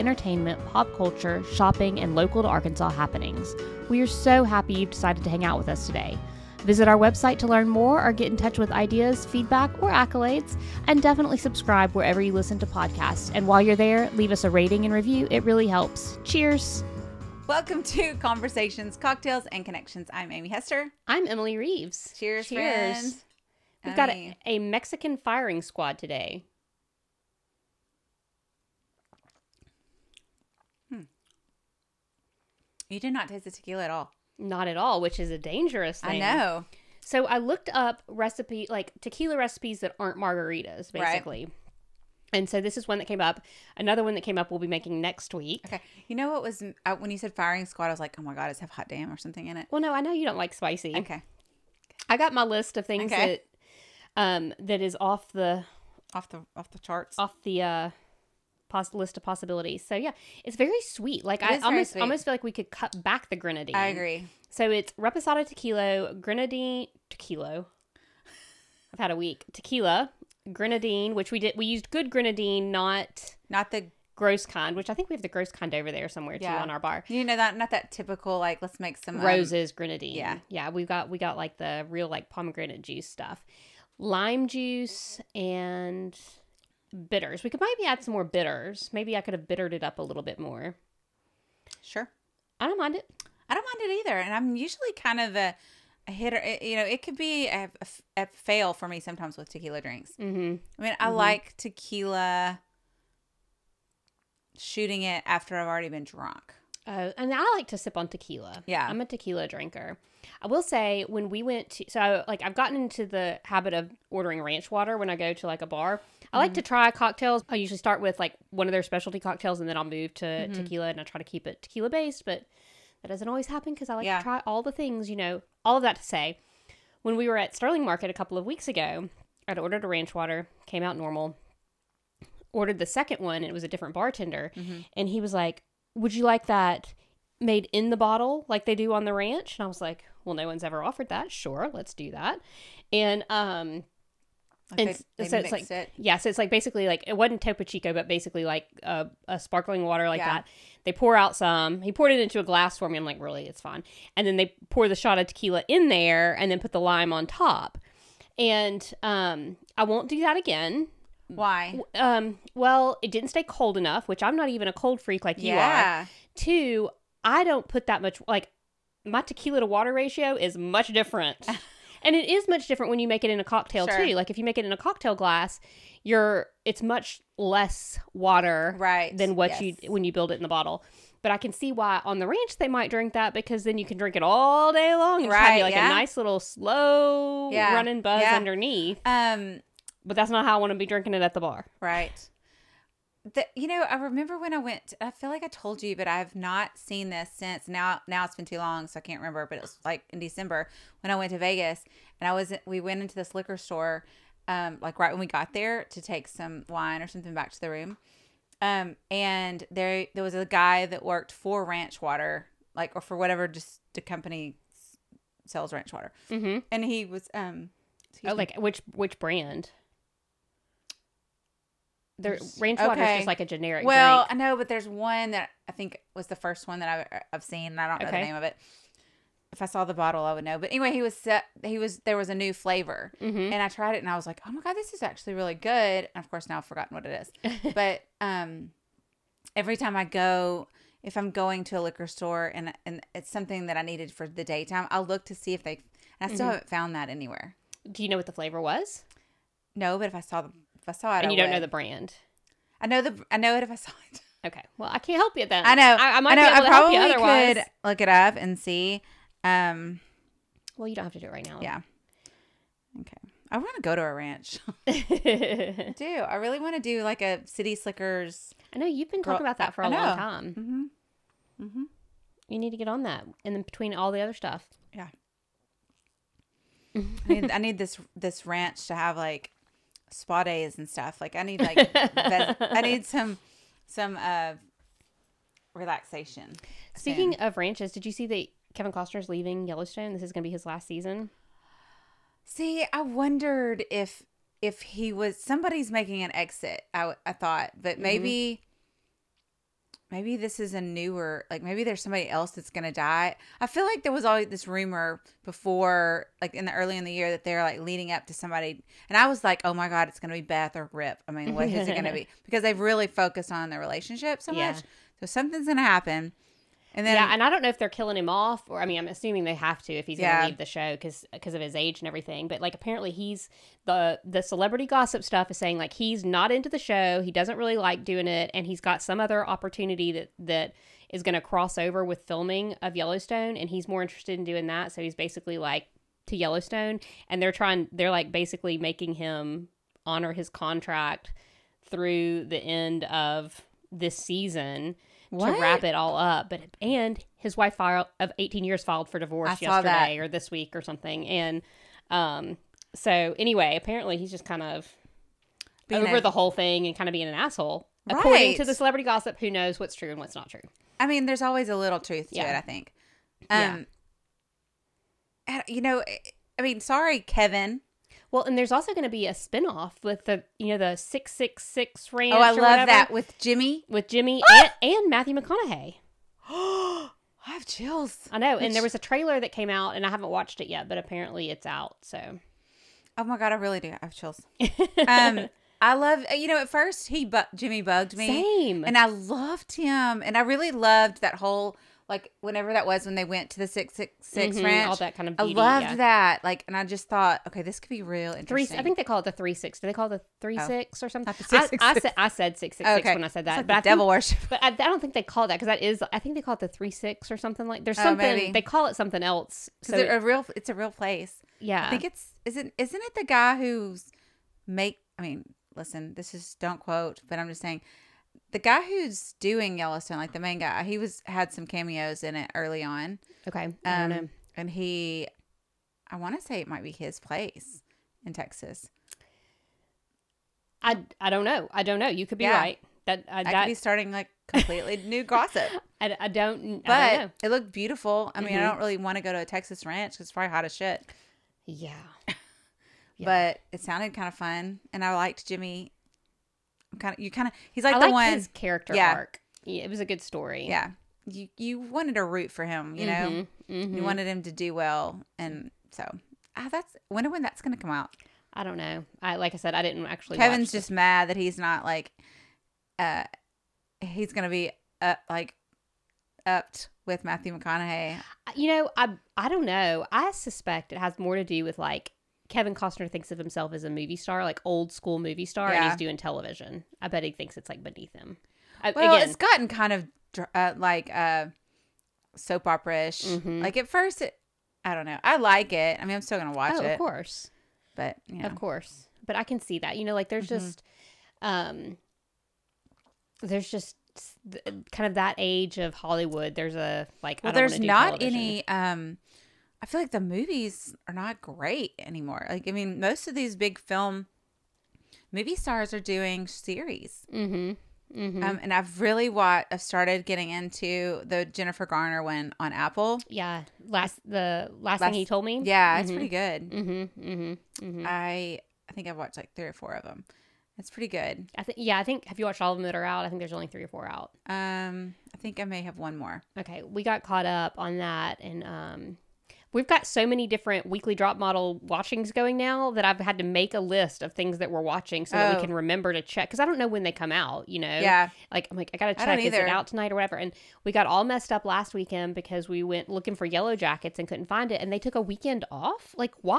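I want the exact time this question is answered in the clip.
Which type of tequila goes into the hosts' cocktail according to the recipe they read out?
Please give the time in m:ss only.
1:04.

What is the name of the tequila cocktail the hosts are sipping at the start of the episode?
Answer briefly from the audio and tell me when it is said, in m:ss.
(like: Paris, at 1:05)
Mexican firing squad, at 0:24.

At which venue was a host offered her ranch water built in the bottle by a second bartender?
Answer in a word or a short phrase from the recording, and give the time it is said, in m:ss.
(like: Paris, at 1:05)
Sterling Market, at 2:07.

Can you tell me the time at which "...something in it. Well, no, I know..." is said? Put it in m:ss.
0:49.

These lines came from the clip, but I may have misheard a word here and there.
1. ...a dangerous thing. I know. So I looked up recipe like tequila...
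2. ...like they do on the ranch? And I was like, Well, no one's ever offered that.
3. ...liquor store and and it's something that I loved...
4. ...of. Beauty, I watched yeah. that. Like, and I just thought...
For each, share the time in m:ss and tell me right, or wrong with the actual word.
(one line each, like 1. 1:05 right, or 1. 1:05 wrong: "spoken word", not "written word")
1. 0:35 right
2. 2:18 right
3. 4:01 wrong: "needed", not "loved"
4. 6:35 wrong: "loved", not "watched".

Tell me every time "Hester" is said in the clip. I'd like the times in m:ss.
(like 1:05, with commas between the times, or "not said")
0:20.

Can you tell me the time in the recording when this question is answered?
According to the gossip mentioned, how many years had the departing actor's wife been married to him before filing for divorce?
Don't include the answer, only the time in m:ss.
5:48.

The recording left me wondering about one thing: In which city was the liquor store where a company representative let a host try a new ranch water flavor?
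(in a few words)
Vegas.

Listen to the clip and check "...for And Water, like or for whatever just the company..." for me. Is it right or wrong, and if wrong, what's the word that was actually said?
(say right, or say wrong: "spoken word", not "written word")
wrong: "Ranch", not "And".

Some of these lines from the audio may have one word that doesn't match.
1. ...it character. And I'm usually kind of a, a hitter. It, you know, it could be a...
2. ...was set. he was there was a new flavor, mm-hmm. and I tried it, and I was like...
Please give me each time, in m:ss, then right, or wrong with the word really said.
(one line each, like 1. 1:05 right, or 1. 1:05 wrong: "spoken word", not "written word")
1. 1:33 wrong: "either", not "character"
2. 3:51 right.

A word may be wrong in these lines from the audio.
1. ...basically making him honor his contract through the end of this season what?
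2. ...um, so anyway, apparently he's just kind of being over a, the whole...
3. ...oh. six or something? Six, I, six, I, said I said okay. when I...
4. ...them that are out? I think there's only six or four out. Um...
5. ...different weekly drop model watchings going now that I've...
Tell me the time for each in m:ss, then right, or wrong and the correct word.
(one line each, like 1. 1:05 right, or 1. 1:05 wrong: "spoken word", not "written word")
1. 5:38 right
2. 5:52 right
3. 6:40 right
4. 8:42 wrong: "three", not "six"
5. 8:50 right.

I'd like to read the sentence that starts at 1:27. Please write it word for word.
We could maybe add some more bitters.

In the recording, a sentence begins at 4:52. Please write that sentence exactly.
See, I wondered if if he was somebody's making an exit.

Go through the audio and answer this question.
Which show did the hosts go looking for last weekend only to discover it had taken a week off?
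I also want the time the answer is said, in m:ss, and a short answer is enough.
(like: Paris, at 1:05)
Yellow Jackets, at 9:03.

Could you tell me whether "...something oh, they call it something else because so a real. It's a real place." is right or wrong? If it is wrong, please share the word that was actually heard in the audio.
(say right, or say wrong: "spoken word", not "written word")
right.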